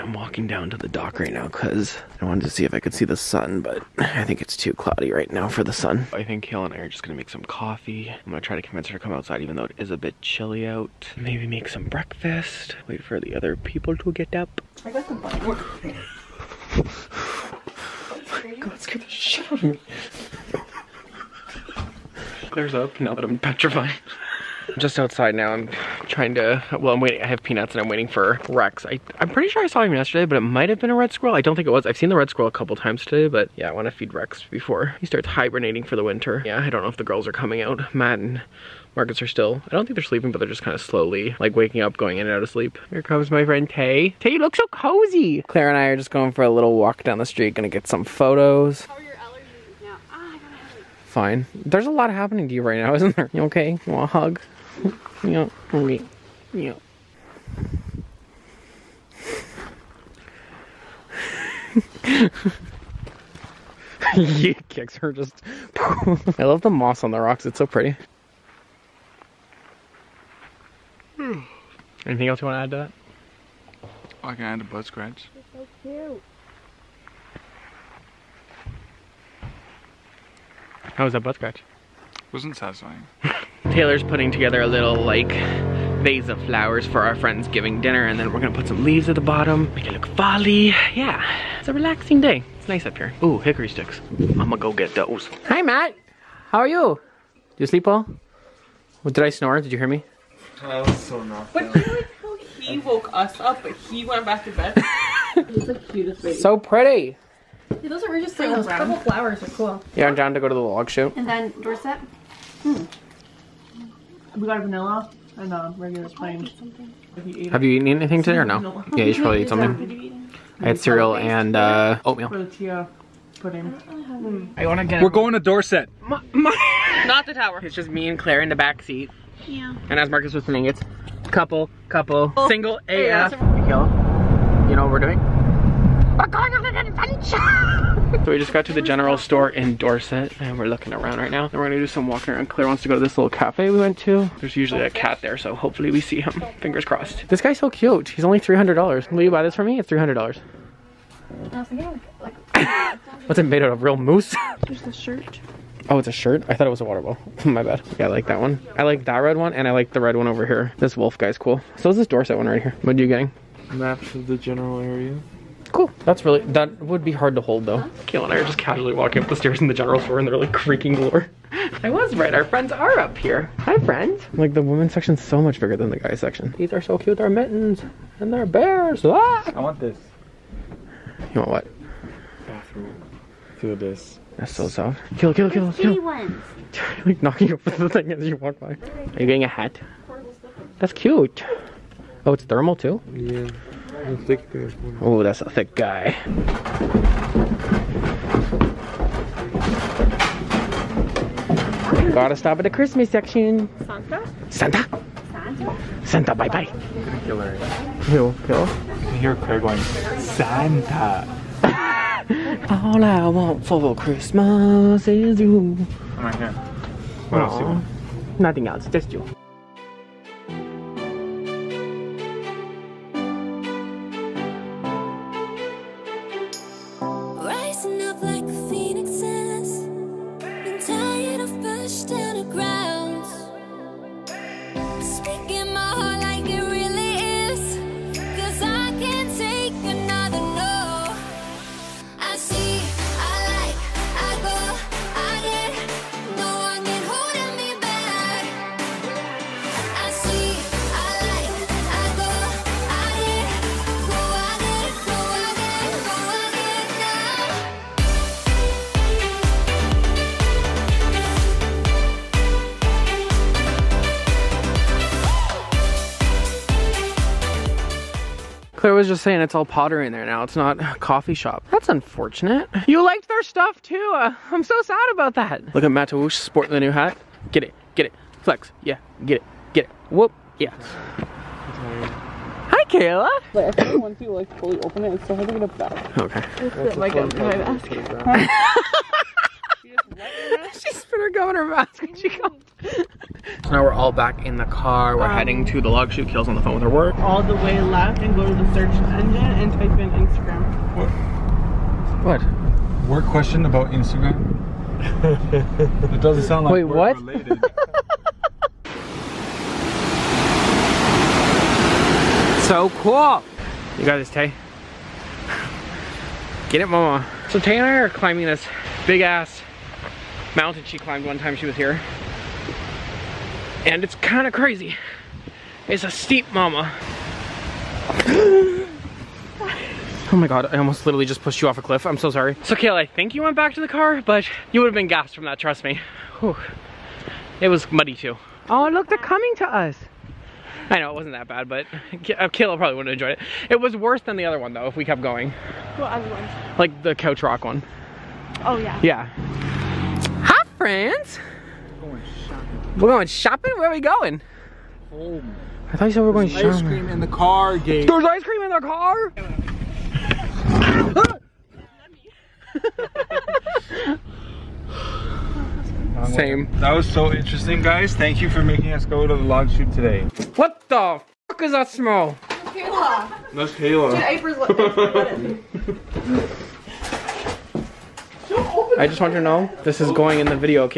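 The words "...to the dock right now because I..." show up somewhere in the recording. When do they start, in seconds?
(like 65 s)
0 s.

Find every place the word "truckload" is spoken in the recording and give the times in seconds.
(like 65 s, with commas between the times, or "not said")
not said.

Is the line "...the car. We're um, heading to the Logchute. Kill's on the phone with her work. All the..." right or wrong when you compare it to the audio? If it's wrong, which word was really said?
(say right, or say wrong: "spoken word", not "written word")
right.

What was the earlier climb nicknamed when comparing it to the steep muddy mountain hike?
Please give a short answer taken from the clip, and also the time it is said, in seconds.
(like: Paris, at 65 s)
The couch rock one, at 347 s.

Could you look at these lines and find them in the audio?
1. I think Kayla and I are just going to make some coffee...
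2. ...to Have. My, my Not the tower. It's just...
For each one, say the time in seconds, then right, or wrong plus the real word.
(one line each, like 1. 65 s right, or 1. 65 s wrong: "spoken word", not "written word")
1. 6 s right
2. 125 s wrong: "Dorset", not "Have".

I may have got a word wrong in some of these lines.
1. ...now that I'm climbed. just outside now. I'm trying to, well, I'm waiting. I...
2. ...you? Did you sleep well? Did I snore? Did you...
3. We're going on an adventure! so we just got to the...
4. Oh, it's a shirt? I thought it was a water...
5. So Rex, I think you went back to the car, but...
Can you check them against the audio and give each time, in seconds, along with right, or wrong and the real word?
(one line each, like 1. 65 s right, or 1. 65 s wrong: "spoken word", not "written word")
1. 23 s wrong: "petrified", not "climbed"
2. 96 s right
3. 136 s right
4. 155 s right
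5. 332 s wrong: "Kayla", not "Rex".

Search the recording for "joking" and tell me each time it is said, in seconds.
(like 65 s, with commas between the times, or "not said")
not said.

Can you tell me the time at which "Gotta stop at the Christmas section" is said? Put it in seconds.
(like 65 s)
202 s.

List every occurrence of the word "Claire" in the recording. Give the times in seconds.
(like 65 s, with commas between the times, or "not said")
45 s, 128 s, 142 s.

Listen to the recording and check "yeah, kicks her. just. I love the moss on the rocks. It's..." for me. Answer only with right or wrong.
right.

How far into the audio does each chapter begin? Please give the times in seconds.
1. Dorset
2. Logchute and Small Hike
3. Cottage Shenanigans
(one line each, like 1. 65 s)
1. 123 s
2. 292 s
3. 369 s.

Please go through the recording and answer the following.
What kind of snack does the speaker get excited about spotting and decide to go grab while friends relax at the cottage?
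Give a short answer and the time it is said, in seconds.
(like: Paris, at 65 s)
Hickory sticks, at 93 s.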